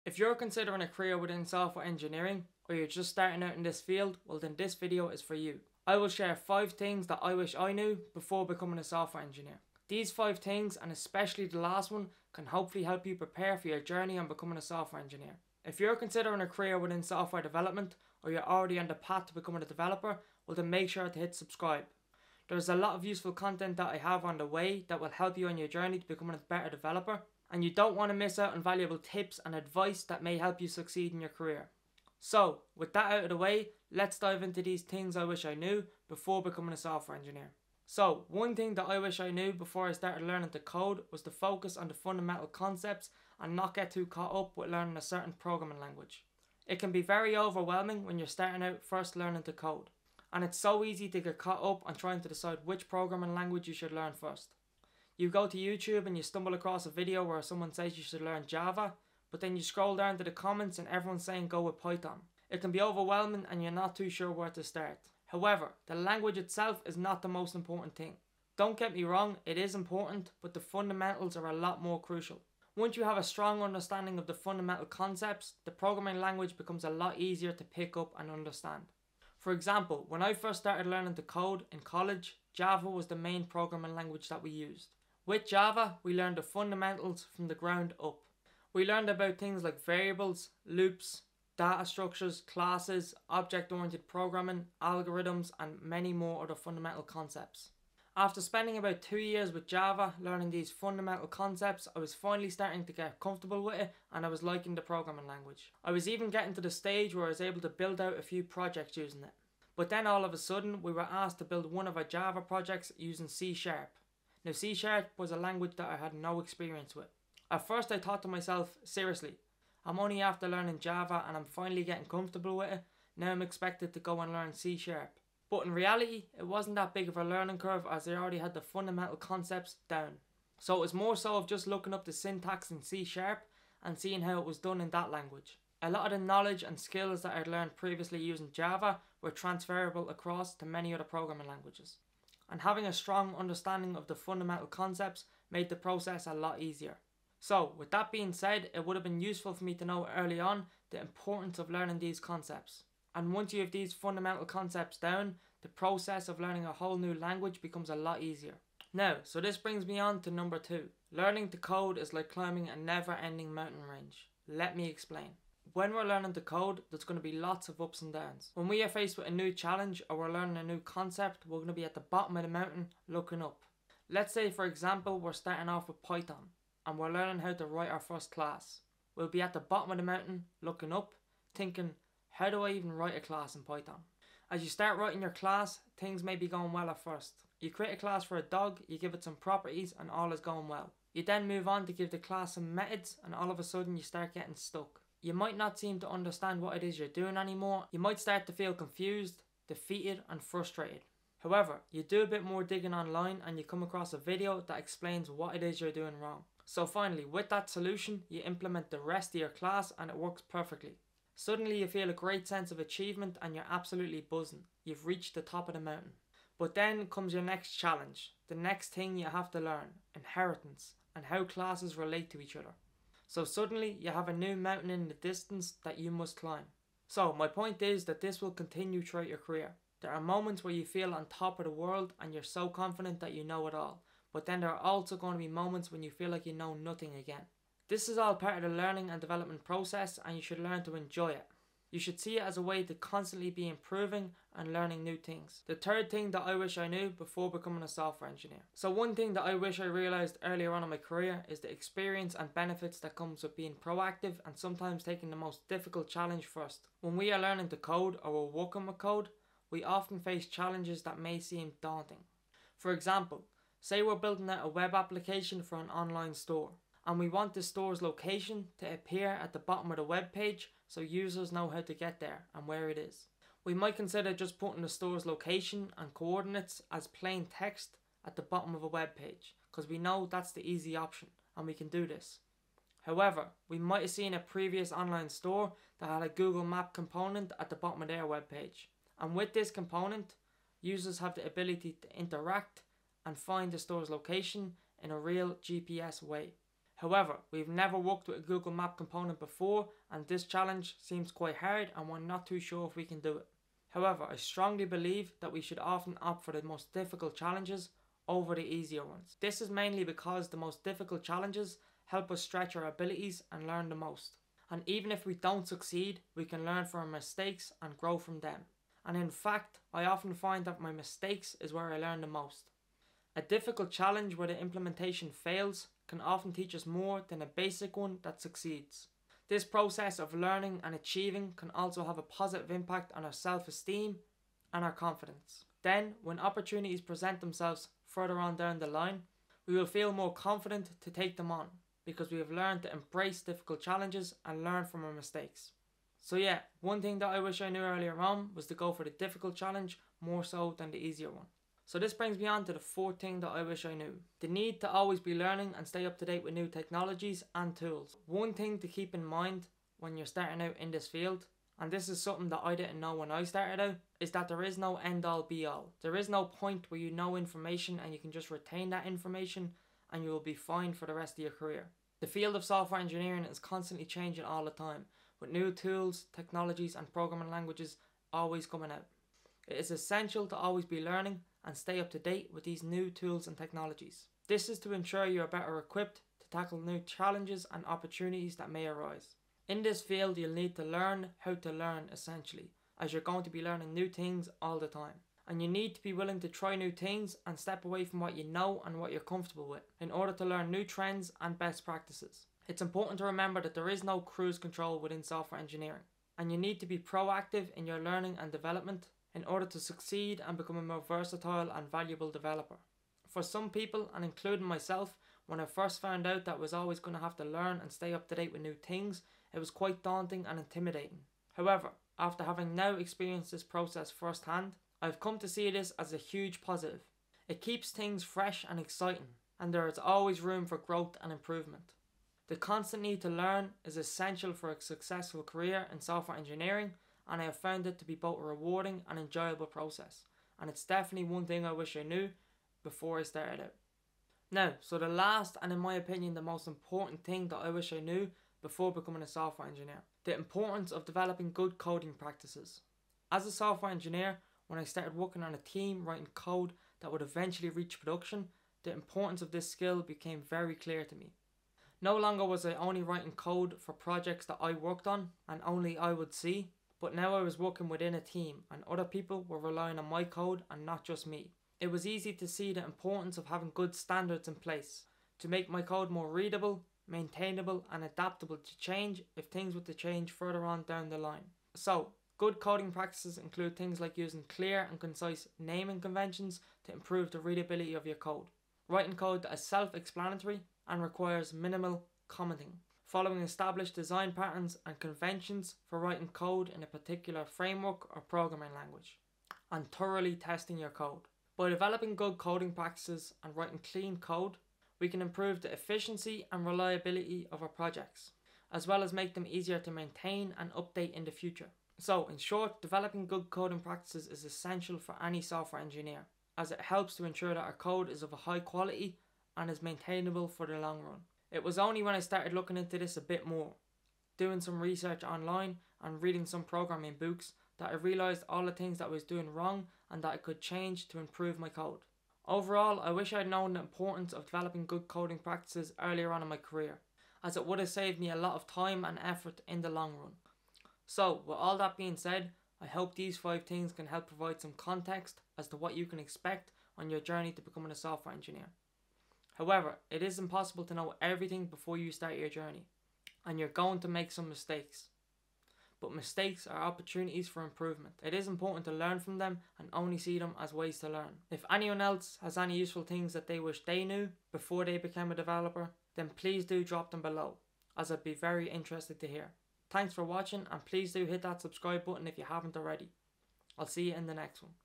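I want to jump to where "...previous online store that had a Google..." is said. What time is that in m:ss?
4:44.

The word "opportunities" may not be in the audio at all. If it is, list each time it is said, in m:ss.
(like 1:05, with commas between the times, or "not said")
5:36, 6:27, 9:16.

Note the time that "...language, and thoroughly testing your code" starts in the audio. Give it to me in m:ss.
8:18.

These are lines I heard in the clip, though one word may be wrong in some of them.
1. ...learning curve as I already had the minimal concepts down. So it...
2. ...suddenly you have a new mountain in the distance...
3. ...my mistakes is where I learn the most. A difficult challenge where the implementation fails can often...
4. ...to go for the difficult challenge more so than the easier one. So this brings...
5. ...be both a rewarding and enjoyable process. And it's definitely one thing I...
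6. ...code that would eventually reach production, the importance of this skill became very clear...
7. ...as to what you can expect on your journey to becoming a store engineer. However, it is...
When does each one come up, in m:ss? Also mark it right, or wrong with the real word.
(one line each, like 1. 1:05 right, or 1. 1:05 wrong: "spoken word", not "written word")
1. 2:07 wrong: "fundamental", not "minimal"
2. 3:43 right
3. 5:20 right
4. 5:48 right
5. 7:18 right
6. 7:36 right
7. 9:05 wrong: "software", not "store".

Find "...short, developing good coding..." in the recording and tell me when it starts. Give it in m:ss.
8:32.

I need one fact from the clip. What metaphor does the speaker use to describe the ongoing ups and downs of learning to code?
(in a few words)
Never ending mountain range.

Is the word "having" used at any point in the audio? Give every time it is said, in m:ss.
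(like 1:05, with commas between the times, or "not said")
2:22, 7:02, 7:53.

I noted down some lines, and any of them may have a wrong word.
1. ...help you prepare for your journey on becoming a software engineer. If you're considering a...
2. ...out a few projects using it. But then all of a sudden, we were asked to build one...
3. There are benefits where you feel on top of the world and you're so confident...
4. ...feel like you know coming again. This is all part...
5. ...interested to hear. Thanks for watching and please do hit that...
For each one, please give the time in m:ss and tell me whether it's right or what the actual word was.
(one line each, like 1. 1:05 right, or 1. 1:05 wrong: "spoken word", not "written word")
1. 0:12 right
2. 1:48 right
3. 3:50 wrong: "moments", not "benefits"
4. 3:56 wrong: "nothing", not "coming"
5. 9:28 right.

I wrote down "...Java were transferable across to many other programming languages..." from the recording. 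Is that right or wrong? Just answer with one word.
right.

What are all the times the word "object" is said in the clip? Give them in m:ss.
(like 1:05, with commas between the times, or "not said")
1:33.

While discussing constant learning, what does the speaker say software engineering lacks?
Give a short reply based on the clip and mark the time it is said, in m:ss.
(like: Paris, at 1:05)
Cruise control, at 6:44.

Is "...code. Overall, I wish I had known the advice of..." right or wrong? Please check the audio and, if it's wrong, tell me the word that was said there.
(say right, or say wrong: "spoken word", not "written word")
wrong: "importance", not "advice".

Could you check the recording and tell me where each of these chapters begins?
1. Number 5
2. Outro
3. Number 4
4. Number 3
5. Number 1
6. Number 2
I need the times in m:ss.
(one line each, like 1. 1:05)
1. 7:33
2. 9:00
3. 5:58
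4. 4:14
5. 0:42
6. 2:40.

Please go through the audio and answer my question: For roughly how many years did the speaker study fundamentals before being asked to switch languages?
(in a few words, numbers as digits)
2 years.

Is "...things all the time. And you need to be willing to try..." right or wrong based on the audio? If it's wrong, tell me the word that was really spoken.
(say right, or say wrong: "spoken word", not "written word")
right.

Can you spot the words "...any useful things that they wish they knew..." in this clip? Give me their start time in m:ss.
9:22.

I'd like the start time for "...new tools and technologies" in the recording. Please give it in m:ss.
6:22.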